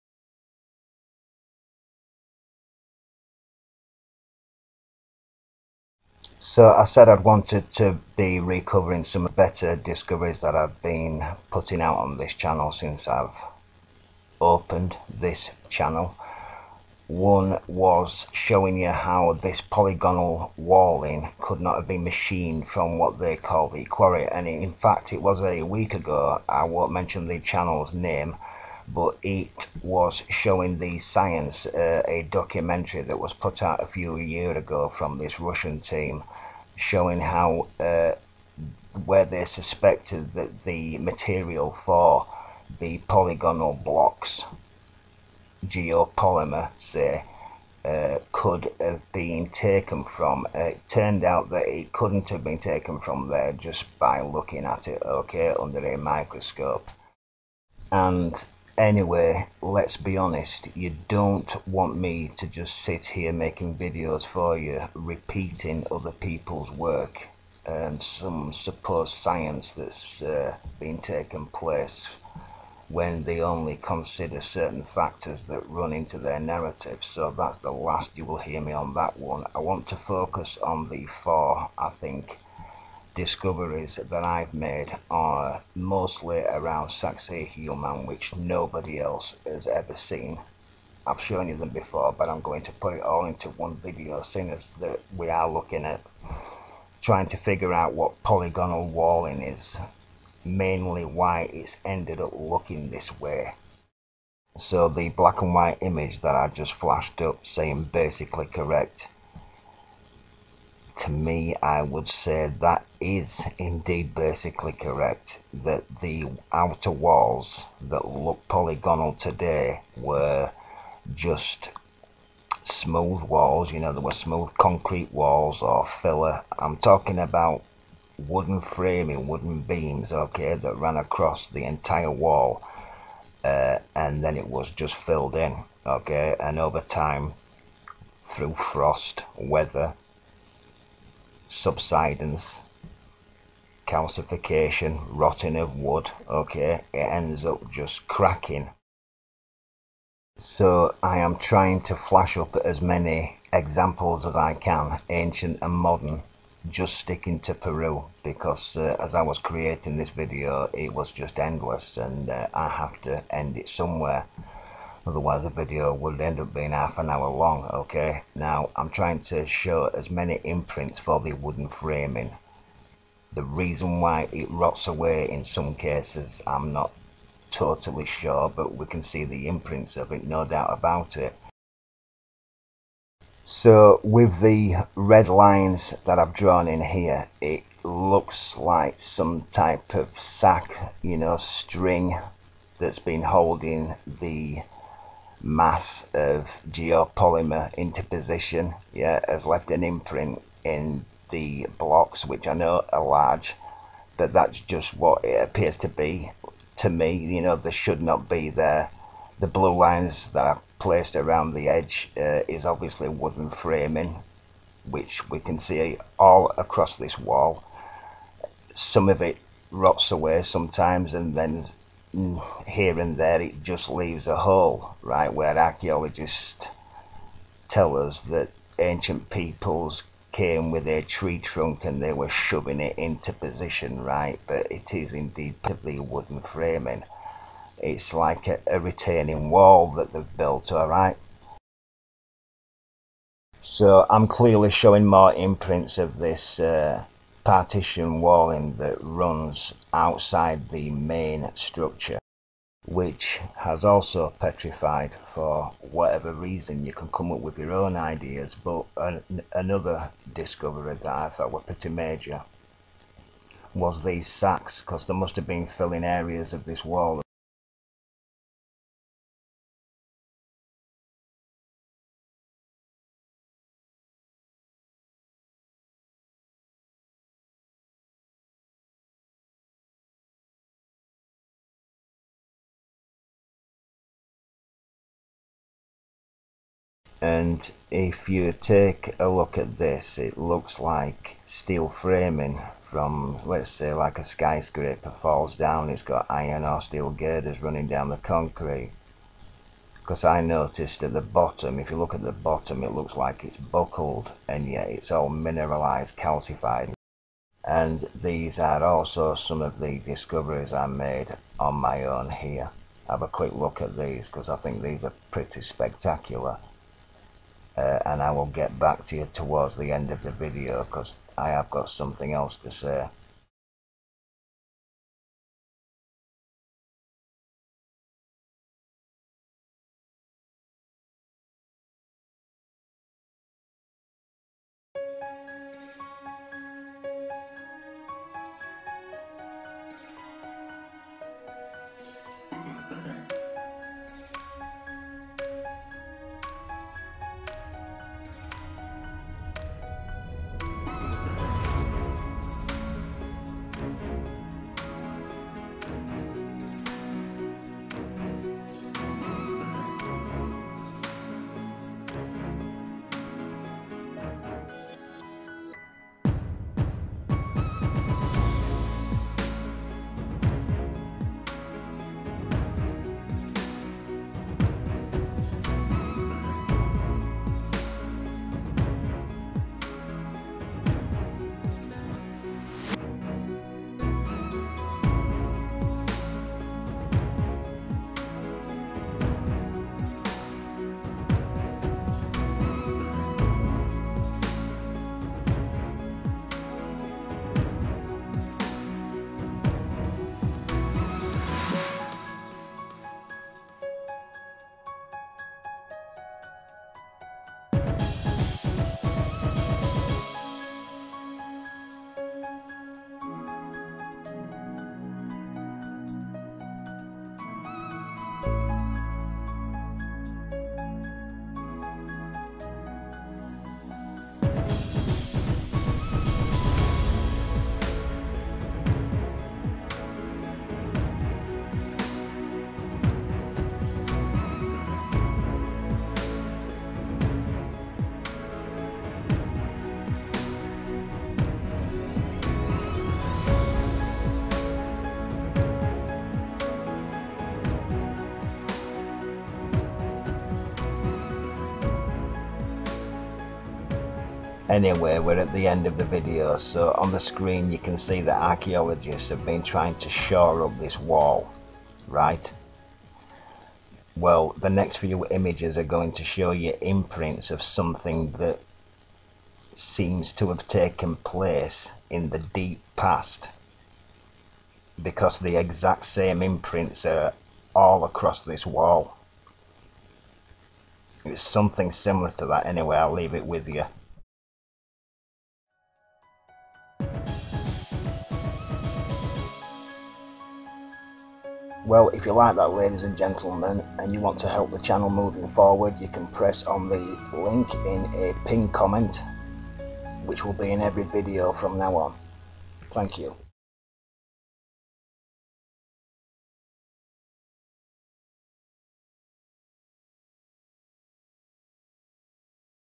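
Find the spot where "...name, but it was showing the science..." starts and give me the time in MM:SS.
00:27.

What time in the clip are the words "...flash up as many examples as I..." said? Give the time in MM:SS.
02:31.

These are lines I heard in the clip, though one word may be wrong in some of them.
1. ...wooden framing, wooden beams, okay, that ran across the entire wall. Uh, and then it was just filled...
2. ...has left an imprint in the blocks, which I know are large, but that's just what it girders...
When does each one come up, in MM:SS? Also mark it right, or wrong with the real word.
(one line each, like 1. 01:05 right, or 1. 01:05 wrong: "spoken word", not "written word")
1. 02:08 right
2. 03:19 wrong: "appears", not "girders".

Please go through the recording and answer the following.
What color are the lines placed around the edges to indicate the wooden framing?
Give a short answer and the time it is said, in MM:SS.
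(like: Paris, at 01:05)
blue, at 03:29.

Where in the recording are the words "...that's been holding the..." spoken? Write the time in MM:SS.
03:12.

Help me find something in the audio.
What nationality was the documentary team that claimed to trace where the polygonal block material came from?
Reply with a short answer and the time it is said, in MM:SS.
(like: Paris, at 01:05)
Russian, at 00:35.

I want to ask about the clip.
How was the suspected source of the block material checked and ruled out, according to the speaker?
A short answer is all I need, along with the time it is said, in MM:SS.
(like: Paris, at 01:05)
under a microscope, at 00:55.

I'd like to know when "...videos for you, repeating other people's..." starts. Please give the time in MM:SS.
01:03.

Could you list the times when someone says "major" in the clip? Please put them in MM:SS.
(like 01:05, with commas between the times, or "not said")
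04:21.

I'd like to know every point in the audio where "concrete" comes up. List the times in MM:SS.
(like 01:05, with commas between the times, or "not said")
02:04, 04:58.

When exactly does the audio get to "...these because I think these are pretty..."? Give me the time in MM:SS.
05:13.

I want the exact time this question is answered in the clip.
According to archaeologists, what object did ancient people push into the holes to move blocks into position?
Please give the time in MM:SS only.
03:50.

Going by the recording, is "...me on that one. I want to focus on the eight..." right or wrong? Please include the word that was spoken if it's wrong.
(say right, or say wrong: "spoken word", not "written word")
wrong: "four", not "eight".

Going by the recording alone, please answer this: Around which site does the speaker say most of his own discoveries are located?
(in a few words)
Saxe Human.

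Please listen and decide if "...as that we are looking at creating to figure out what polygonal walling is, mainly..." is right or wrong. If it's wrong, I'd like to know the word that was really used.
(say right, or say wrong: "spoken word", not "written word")
wrong: "trying", not "creating".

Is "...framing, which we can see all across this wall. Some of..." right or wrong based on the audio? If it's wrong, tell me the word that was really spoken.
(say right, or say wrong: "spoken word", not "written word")
right.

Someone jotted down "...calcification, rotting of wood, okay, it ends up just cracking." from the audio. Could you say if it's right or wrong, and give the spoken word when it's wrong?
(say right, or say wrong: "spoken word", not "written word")
right.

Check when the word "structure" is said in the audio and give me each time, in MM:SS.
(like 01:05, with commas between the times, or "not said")
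04:11.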